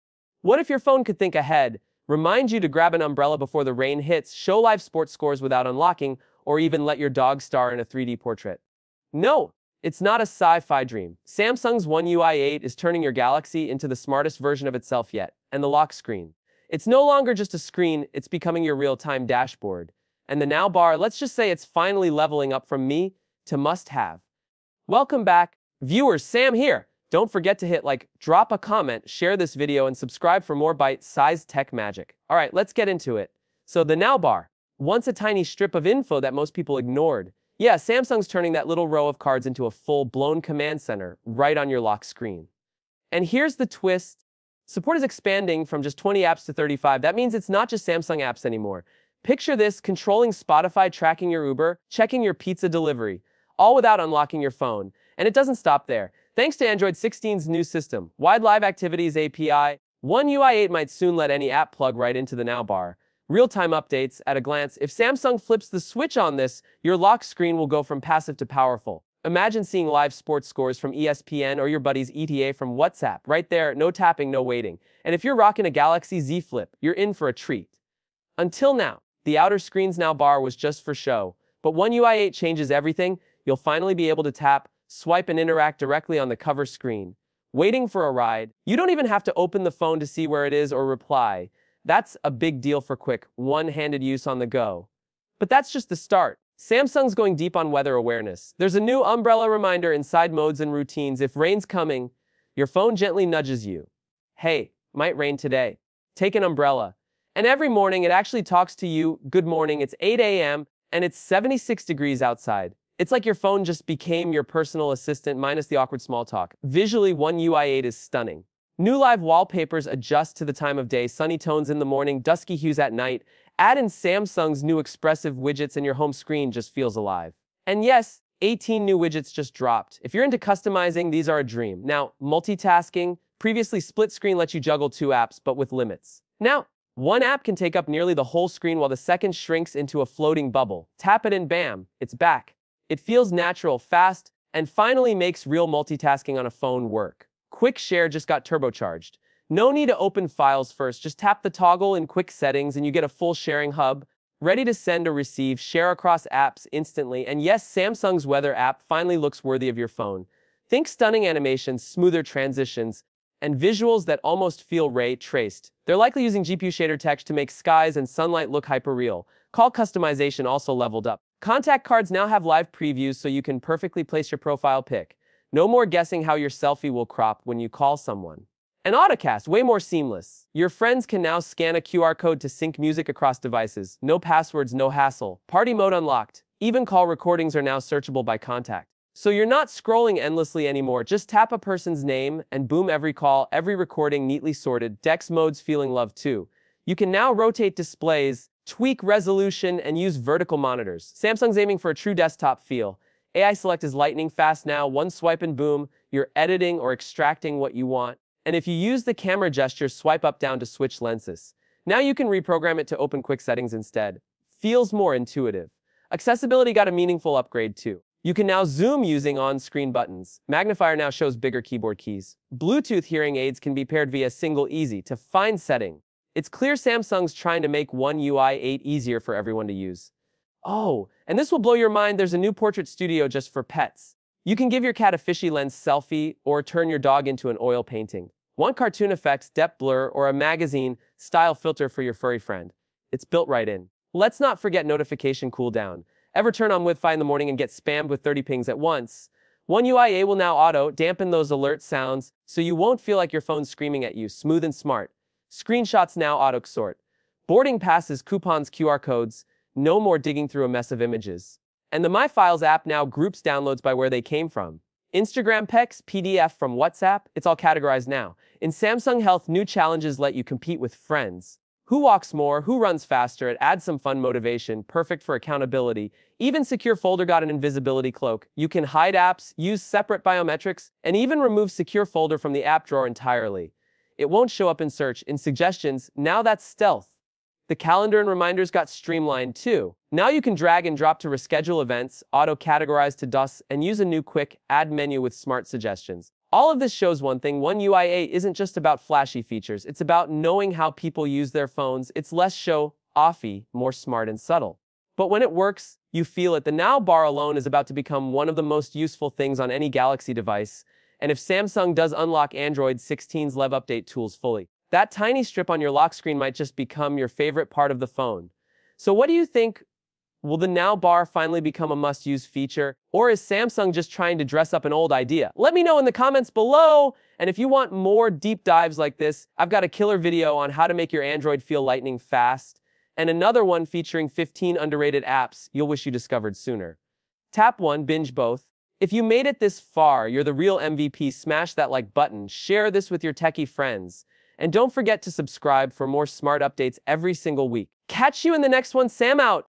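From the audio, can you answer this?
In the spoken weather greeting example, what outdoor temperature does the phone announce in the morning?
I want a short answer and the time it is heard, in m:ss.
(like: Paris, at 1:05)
76 degrees, at 1:51.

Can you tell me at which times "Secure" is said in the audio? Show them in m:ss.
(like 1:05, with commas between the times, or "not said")
4:36, 4:41.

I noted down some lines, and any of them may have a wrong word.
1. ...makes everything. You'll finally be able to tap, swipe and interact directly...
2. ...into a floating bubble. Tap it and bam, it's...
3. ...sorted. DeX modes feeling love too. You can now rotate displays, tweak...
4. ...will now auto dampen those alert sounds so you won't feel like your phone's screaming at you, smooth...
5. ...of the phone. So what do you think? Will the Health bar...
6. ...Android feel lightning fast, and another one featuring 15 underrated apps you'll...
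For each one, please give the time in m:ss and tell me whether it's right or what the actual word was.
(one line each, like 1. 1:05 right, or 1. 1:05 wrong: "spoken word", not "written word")
1. 1:22 wrong: "changes", not "makes"
2. 2:19 right
3. 3:14 right
4. 4:10 right
5. 5:17 wrong: "Now", not "Health"
6. 5:31 right.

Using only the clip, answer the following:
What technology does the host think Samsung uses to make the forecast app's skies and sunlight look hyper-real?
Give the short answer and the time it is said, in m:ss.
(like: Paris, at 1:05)
GPU shader tech, at 2:46.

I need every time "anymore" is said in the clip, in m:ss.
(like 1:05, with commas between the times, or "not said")
0:48, 3:10.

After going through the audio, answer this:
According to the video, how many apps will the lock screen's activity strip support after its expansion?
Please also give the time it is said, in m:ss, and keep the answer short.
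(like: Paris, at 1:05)
35, at 0:46.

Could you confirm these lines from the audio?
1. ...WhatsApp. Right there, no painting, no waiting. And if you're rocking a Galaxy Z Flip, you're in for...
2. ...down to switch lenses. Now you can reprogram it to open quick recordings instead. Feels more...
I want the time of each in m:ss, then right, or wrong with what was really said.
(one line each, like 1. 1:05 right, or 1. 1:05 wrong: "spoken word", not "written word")
1. 1:12 wrong: "tapping", not "painting"
2. 3:30 wrong: "settings", not "recordings".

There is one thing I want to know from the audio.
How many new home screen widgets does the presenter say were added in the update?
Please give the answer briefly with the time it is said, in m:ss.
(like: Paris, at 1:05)
18, at 2:08.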